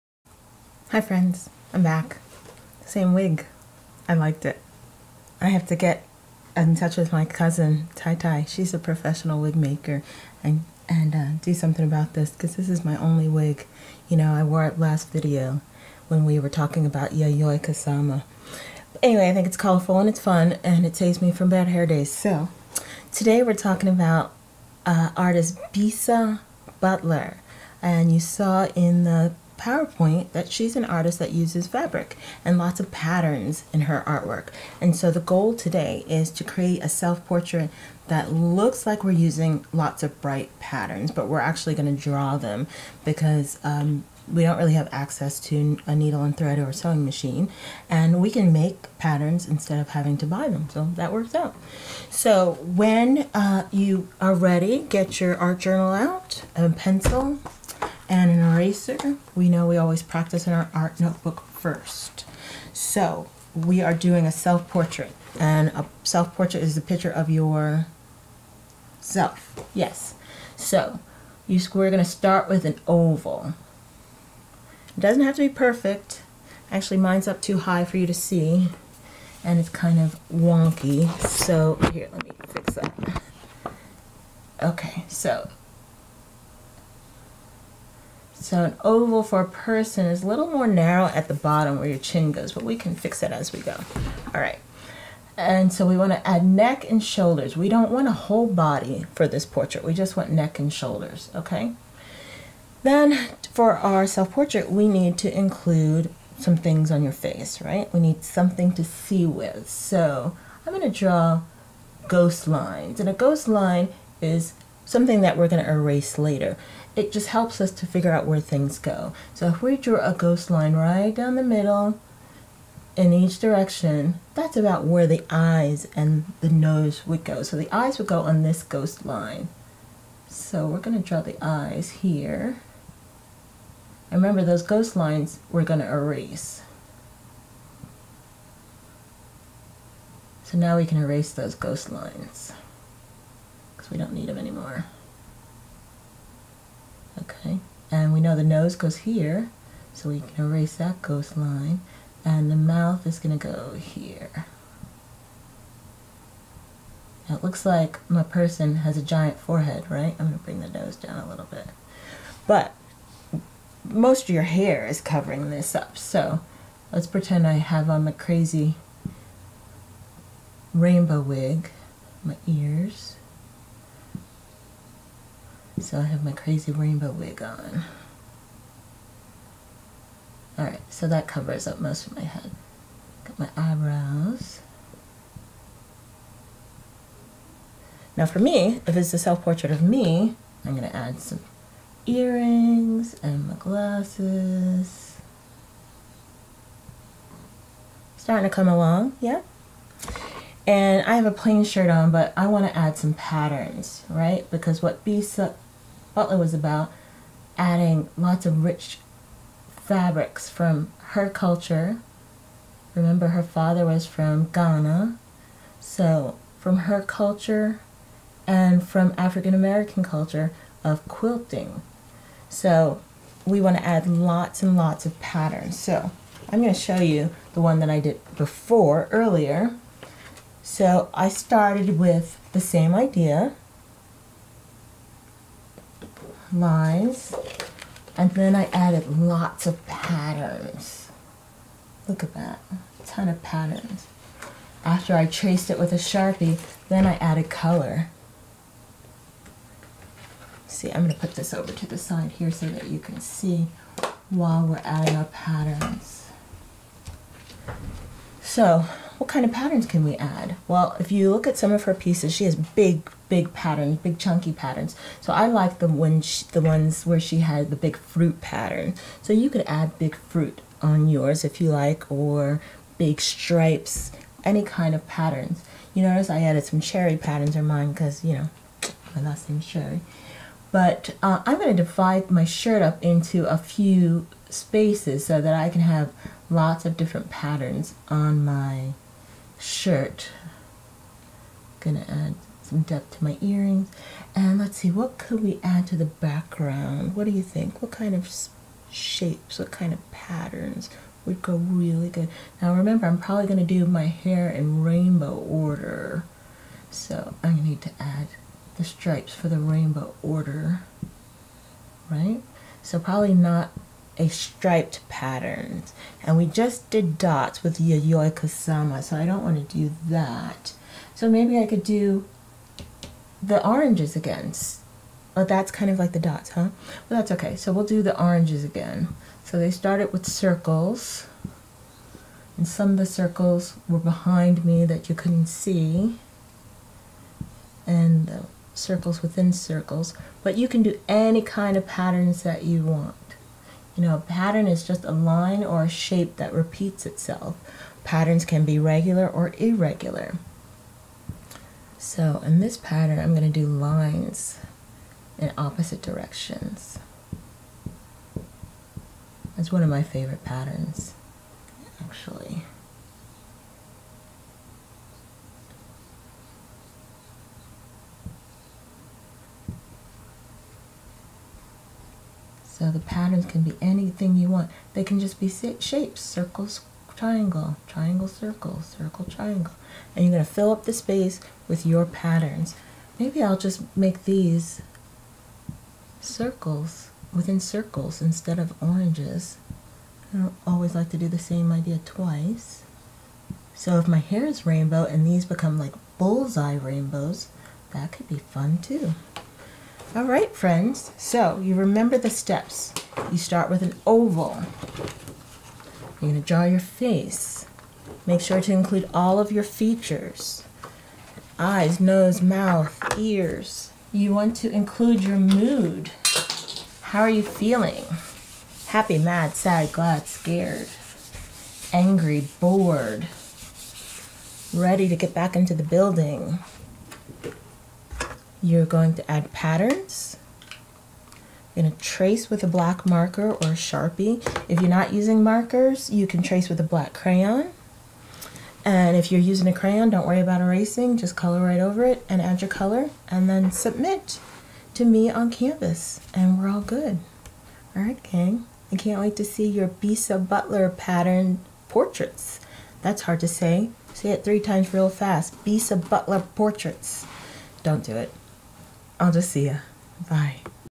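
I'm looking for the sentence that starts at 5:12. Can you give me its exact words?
So probably not a striped pattern.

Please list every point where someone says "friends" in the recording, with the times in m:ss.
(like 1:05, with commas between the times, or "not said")
0:00, 6:40.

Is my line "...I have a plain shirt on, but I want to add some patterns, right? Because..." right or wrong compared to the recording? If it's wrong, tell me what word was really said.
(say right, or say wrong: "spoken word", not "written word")
right.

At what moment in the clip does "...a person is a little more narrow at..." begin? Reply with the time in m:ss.
1:29.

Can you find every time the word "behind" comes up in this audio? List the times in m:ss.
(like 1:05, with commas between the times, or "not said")
5:33.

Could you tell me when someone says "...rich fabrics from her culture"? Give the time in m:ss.
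3:28.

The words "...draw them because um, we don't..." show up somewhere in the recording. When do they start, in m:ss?
0:42.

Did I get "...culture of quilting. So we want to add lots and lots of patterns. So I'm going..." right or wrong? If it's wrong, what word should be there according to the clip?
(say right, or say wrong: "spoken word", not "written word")
right.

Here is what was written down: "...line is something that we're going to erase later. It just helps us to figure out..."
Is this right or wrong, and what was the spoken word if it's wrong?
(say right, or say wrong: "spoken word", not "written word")
right.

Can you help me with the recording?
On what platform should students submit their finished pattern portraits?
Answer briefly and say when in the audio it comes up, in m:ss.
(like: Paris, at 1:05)
Canvas, at 7:25.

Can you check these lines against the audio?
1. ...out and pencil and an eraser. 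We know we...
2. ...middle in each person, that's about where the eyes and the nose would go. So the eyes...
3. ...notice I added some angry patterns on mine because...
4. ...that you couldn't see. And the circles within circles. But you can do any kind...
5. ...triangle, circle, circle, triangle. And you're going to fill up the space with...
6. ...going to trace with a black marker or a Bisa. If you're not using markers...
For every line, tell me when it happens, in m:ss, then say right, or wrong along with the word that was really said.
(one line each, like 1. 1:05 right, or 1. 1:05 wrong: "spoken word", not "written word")
1. 0:55 right
2. 2:01 wrong: "direction", not "person"
3. 4:36 wrong: "cherry", not "angry"
4. 5:34 right
5. 6:17 right
6. 7:11 wrong: "Sharpie", not "Bisa".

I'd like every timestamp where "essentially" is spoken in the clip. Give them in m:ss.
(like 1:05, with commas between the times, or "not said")
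not said.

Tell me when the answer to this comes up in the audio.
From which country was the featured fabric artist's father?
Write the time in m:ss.
3:34.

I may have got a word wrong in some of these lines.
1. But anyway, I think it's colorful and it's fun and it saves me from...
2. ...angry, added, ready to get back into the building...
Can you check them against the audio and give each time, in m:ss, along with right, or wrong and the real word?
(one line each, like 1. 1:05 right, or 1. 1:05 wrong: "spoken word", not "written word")
1. 0:18 right
2. 7:01 wrong: "bored", not "added".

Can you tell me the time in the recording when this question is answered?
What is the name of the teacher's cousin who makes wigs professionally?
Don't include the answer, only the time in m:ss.
0:07.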